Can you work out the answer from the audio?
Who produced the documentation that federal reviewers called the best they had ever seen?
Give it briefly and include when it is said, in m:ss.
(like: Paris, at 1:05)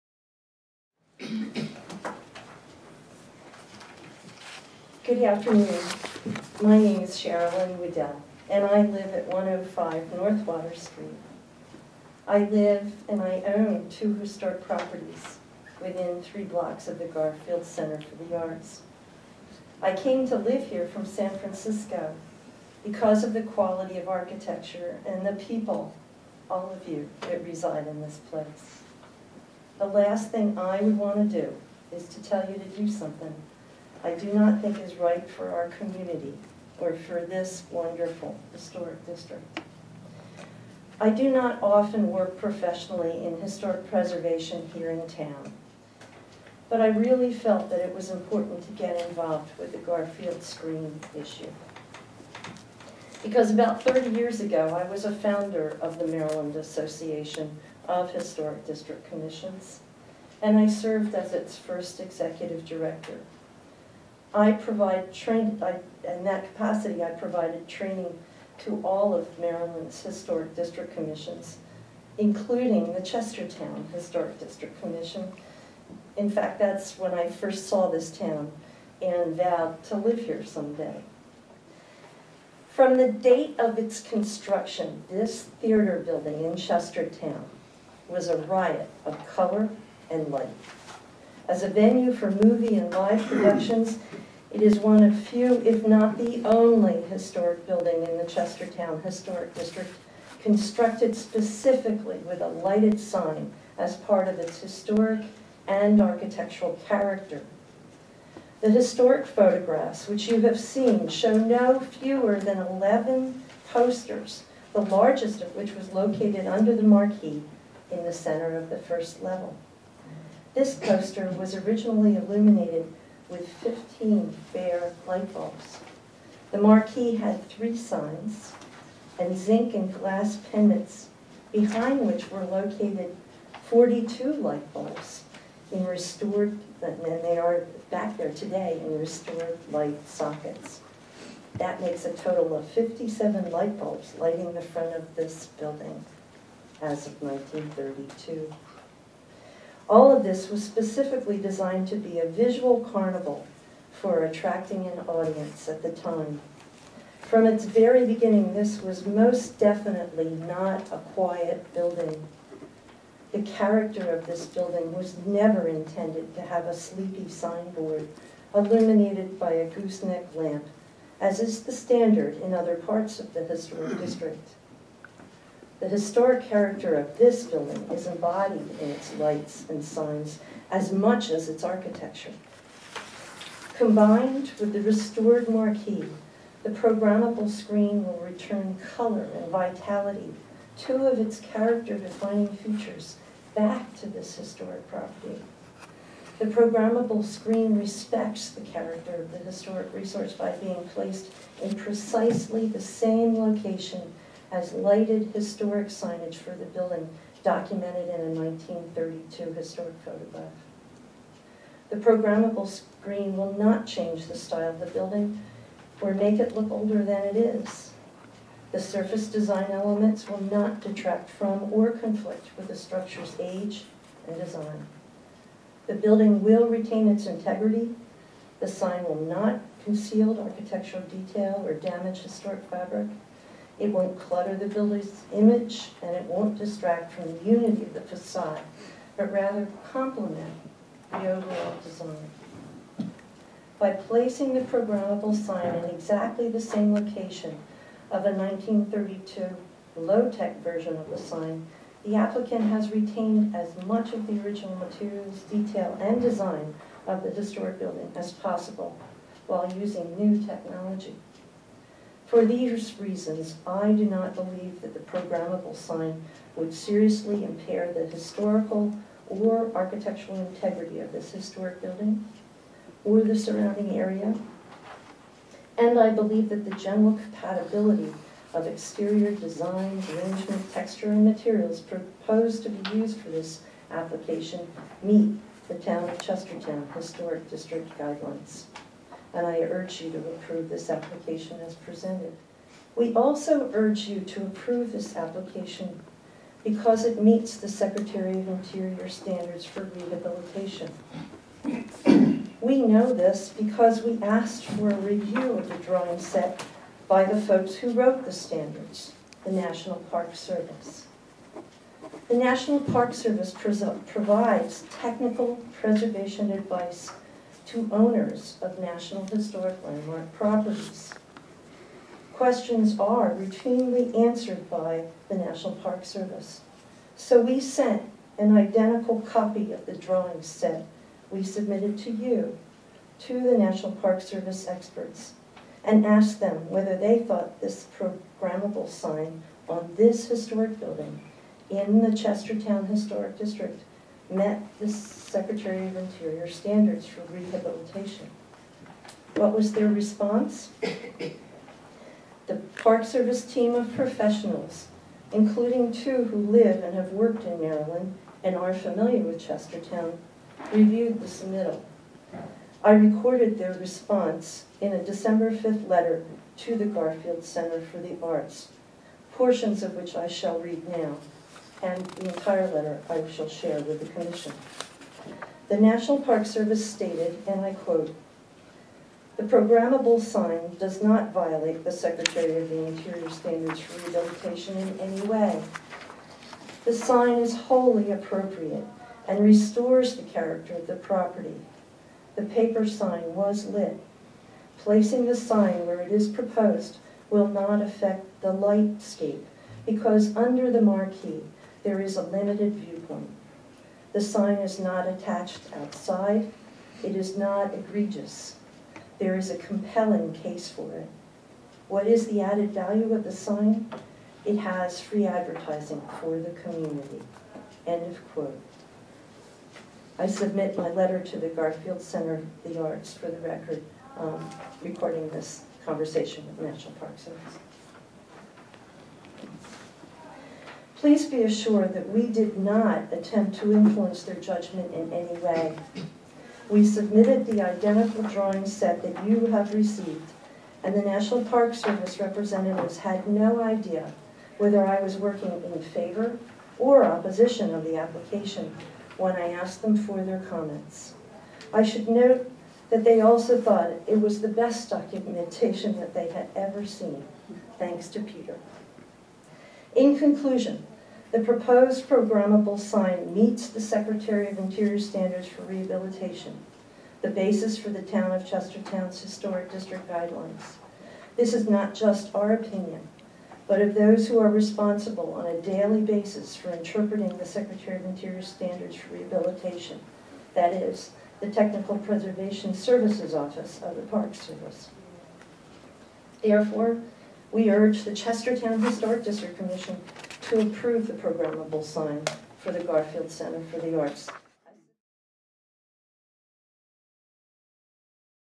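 Peter, at 7:38.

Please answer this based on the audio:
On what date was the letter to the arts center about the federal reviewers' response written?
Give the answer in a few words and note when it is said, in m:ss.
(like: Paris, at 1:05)
December 5, at 6:05.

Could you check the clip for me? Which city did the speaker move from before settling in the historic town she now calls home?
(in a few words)
San Francisco.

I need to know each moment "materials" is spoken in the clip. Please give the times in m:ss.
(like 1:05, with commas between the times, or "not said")
4:14, 4:41.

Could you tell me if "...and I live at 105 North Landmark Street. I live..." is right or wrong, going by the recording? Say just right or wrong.
wrong.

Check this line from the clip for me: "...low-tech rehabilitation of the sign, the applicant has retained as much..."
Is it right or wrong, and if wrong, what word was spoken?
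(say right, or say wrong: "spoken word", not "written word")
wrong: "version", not "rehabilitation".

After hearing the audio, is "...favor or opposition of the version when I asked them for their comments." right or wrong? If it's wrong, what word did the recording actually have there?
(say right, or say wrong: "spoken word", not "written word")
wrong: "application", not "version".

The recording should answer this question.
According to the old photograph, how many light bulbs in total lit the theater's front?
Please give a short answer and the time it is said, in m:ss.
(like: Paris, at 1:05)
57, at 2:22.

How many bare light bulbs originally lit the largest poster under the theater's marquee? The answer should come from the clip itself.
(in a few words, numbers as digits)
15.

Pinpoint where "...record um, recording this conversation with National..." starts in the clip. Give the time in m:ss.
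7:03.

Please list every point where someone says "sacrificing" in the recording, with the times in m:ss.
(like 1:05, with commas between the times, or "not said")
not said.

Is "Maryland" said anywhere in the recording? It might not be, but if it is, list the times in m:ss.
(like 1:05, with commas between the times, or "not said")
0:56, 1:09, 5:57.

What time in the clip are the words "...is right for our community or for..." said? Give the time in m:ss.
0:34.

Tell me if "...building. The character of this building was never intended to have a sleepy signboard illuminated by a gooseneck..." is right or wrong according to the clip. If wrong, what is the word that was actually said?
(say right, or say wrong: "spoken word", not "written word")
right.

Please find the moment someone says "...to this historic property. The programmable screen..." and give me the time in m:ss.
3:14.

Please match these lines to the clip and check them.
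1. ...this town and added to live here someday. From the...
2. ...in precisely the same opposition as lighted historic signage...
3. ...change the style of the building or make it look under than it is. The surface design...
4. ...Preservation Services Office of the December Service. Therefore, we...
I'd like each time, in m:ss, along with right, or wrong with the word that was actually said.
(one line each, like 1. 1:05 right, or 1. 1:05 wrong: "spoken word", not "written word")
1. 1:17 wrong: "vowed", not "added"
2. 3:21 wrong: "location", not "opposition"
3. 3:33 wrong: "older", not "under"
4. 8:01 wrong: "Park", not "December".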